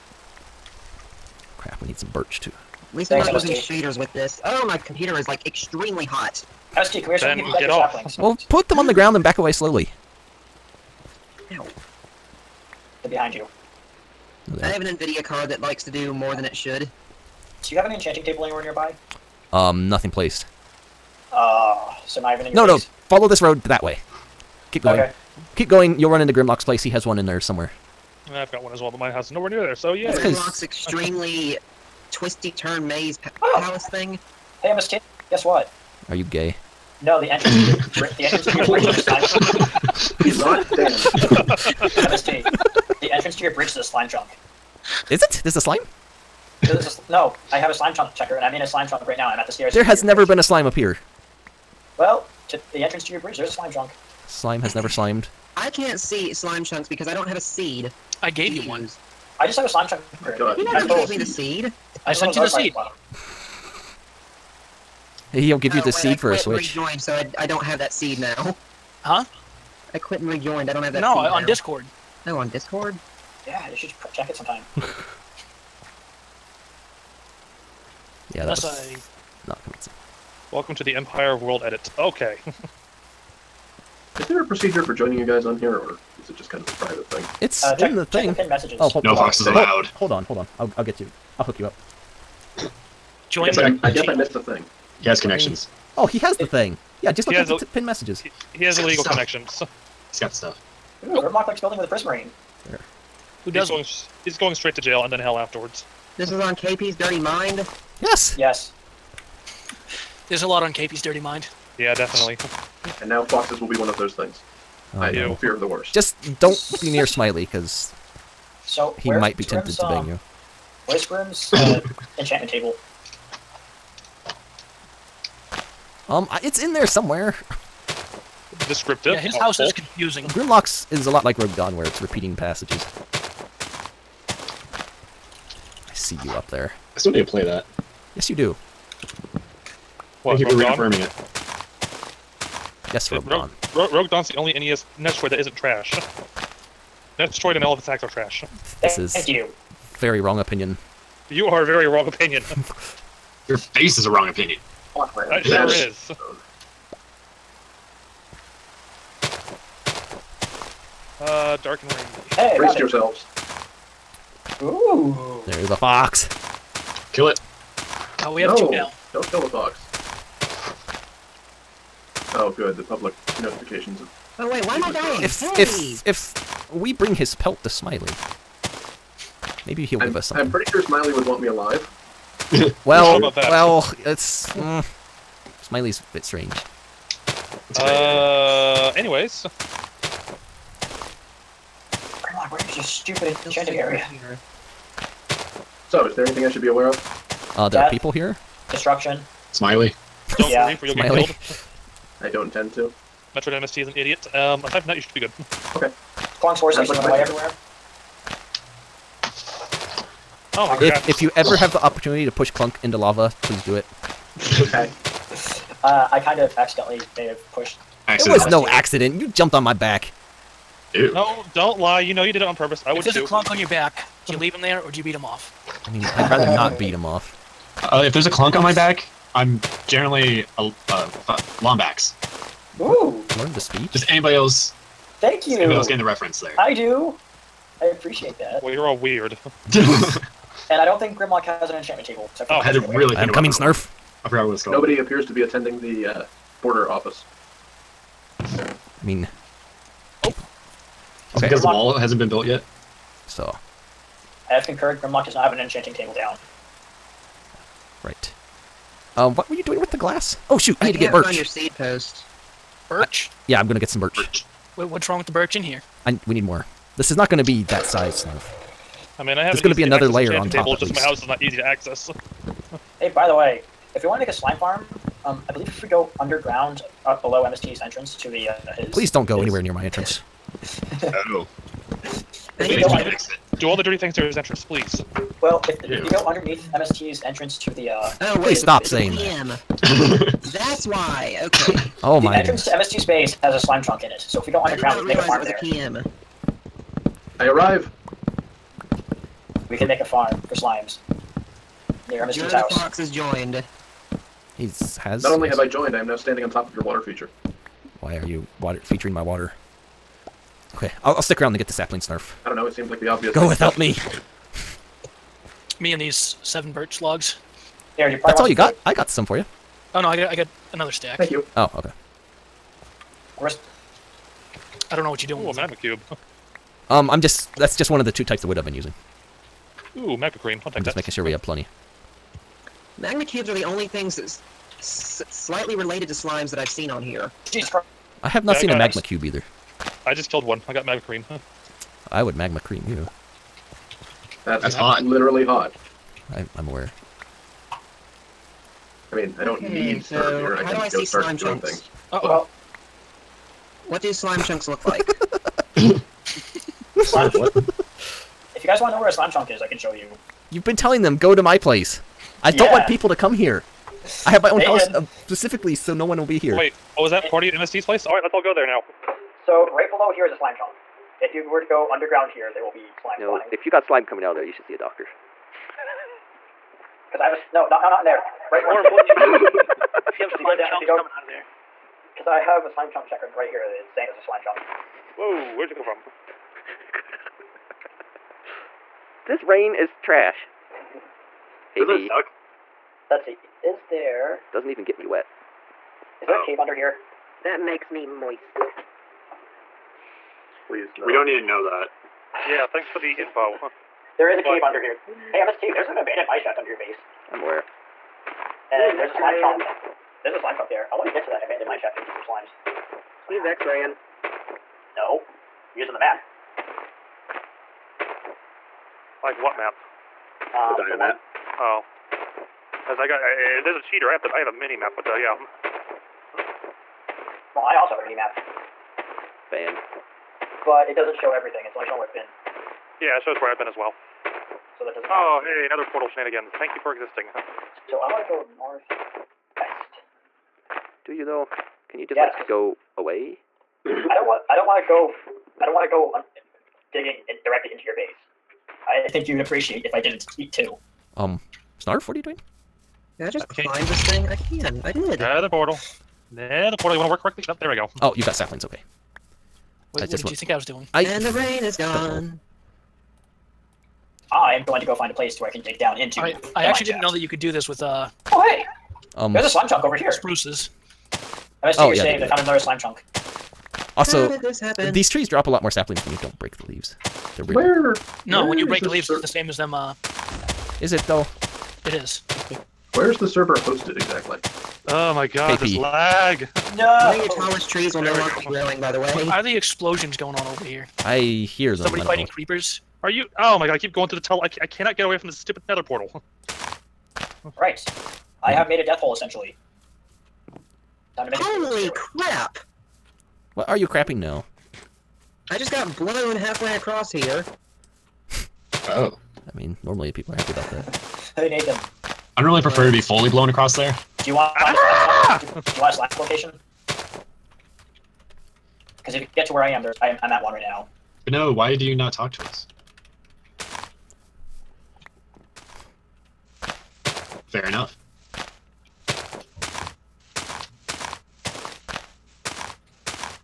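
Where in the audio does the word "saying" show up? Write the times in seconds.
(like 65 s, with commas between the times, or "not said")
288 s, 383 s, 472 s.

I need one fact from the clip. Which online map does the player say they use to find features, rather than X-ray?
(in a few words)
Dynmap.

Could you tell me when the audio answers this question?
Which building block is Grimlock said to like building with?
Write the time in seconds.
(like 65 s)
101 s.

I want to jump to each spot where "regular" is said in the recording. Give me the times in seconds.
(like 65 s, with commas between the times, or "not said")
38 s.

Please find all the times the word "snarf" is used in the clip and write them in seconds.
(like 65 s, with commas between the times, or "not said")
243 s, 268 s, 311 s, 451 s.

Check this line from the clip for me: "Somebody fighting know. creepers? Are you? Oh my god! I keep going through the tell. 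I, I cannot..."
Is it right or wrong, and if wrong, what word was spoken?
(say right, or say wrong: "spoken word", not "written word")
right.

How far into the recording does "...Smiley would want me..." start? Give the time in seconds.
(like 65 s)
180 s.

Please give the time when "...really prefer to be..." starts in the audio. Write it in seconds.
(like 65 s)
512 s.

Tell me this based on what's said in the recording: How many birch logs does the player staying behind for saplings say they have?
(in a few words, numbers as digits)
7.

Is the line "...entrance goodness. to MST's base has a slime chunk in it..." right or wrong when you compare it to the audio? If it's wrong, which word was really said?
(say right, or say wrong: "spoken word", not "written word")
right.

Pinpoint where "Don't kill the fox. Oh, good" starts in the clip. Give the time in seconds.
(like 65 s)
169 s.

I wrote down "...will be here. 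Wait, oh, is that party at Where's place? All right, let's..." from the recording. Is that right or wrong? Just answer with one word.
wrong.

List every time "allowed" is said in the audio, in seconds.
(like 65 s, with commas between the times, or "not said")
89 s.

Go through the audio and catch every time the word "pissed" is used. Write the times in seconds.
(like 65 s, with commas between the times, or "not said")
not said.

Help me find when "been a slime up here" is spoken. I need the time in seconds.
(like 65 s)
50 s.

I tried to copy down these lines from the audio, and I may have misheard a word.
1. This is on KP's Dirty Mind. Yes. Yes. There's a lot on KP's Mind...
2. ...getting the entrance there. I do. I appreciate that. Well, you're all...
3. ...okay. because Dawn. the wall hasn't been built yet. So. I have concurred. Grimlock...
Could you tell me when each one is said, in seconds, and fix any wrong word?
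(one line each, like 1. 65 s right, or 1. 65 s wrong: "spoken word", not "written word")
1. 106 s wrong: "Dirty", not "Mind"
2. 235 s wrong: "reference", not "entrance"
3. 251 s wrong: "Grimlock", not "Dawn".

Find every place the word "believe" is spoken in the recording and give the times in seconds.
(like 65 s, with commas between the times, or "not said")
200 s, 275 s.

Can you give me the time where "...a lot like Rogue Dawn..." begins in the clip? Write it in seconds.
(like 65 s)
131 s.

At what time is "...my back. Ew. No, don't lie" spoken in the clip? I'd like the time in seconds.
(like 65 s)
219 s.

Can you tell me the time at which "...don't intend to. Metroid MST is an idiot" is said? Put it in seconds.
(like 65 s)
202 s.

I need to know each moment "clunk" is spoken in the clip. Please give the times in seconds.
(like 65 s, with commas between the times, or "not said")
206 s, 212 s, 223 s, 228 s.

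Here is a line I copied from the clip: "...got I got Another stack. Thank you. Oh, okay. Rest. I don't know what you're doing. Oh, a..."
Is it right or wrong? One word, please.
right.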